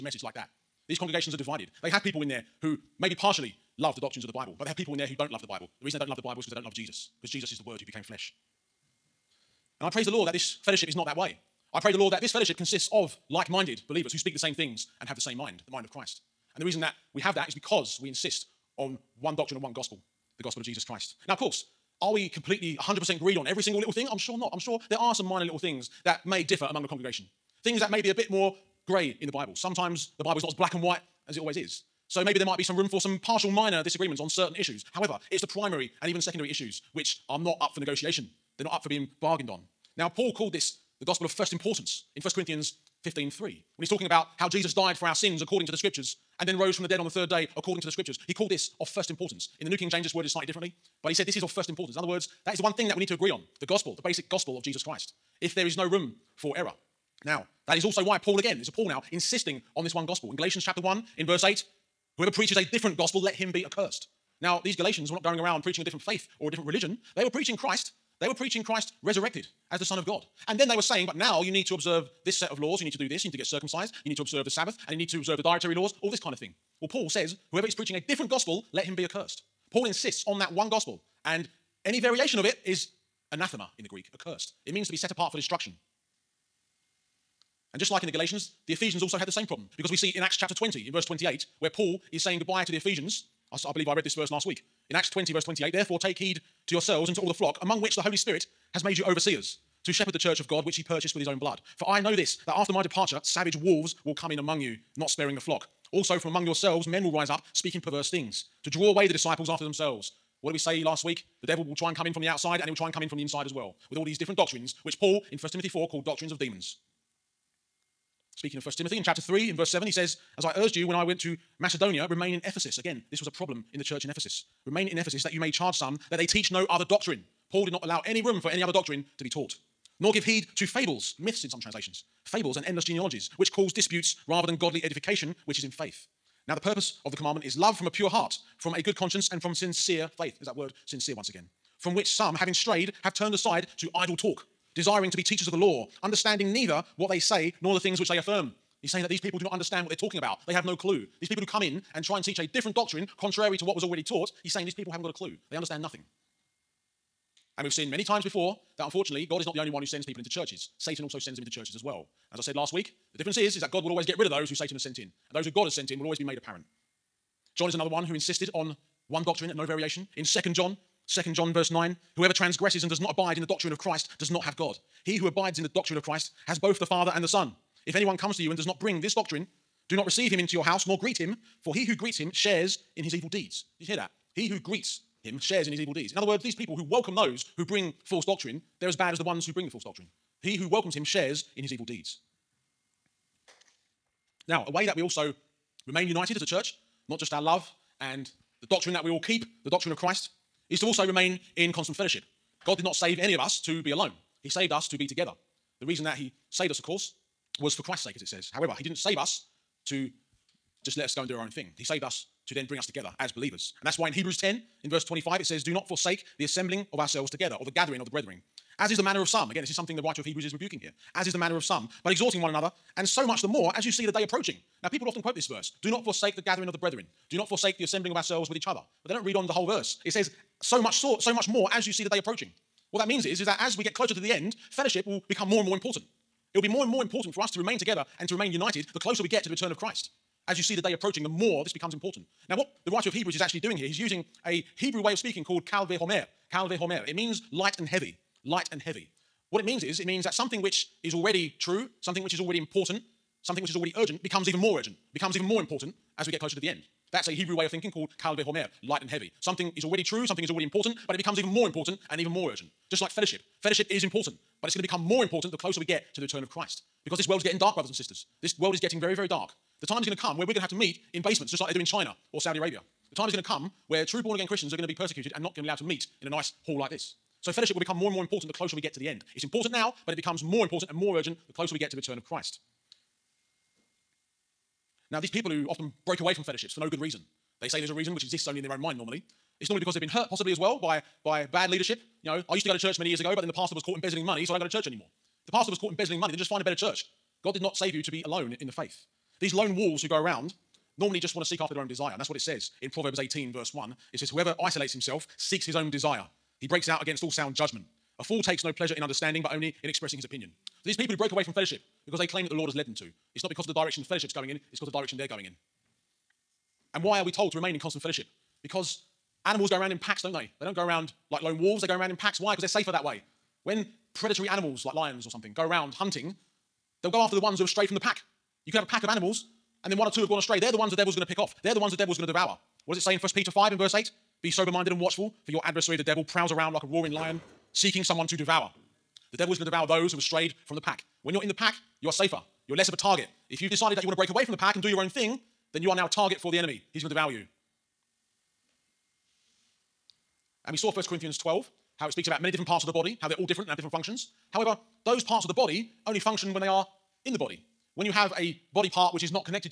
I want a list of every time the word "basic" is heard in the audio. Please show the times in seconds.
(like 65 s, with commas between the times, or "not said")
53 s.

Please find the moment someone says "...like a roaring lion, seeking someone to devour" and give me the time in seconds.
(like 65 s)
336 s.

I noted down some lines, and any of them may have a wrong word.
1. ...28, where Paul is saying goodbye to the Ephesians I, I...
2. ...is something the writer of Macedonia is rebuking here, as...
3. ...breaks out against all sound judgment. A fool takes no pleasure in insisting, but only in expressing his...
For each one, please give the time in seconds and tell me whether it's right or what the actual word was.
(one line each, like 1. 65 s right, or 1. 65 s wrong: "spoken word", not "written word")
1. 91 s right
2. 219 s wrong: "Hebrews", not "Macedonia"
3. 306 s wrong: "understanding", not "insisting".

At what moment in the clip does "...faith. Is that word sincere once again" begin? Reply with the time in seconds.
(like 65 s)
140 s.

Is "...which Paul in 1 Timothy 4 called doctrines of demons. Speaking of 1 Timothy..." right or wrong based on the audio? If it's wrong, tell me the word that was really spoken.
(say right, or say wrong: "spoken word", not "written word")
right.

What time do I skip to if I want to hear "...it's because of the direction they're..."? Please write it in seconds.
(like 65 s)
314 s.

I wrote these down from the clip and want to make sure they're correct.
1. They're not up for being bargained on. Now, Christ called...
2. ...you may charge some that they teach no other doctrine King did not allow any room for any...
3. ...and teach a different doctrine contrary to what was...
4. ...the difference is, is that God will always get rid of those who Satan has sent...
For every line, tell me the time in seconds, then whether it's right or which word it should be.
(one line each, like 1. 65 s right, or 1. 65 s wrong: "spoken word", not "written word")
1. 38 s wrong: "Paul", not "Christ"
2. 125 s wrong: "Paul", not "King"
3. 152 s right
4. 163 s right.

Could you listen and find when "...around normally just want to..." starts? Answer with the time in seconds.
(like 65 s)
300 s.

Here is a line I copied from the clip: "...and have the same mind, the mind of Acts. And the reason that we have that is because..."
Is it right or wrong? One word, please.
wrong.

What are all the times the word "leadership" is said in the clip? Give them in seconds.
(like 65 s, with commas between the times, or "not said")
291 s.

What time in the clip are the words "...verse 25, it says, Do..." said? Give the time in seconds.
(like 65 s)
214 s.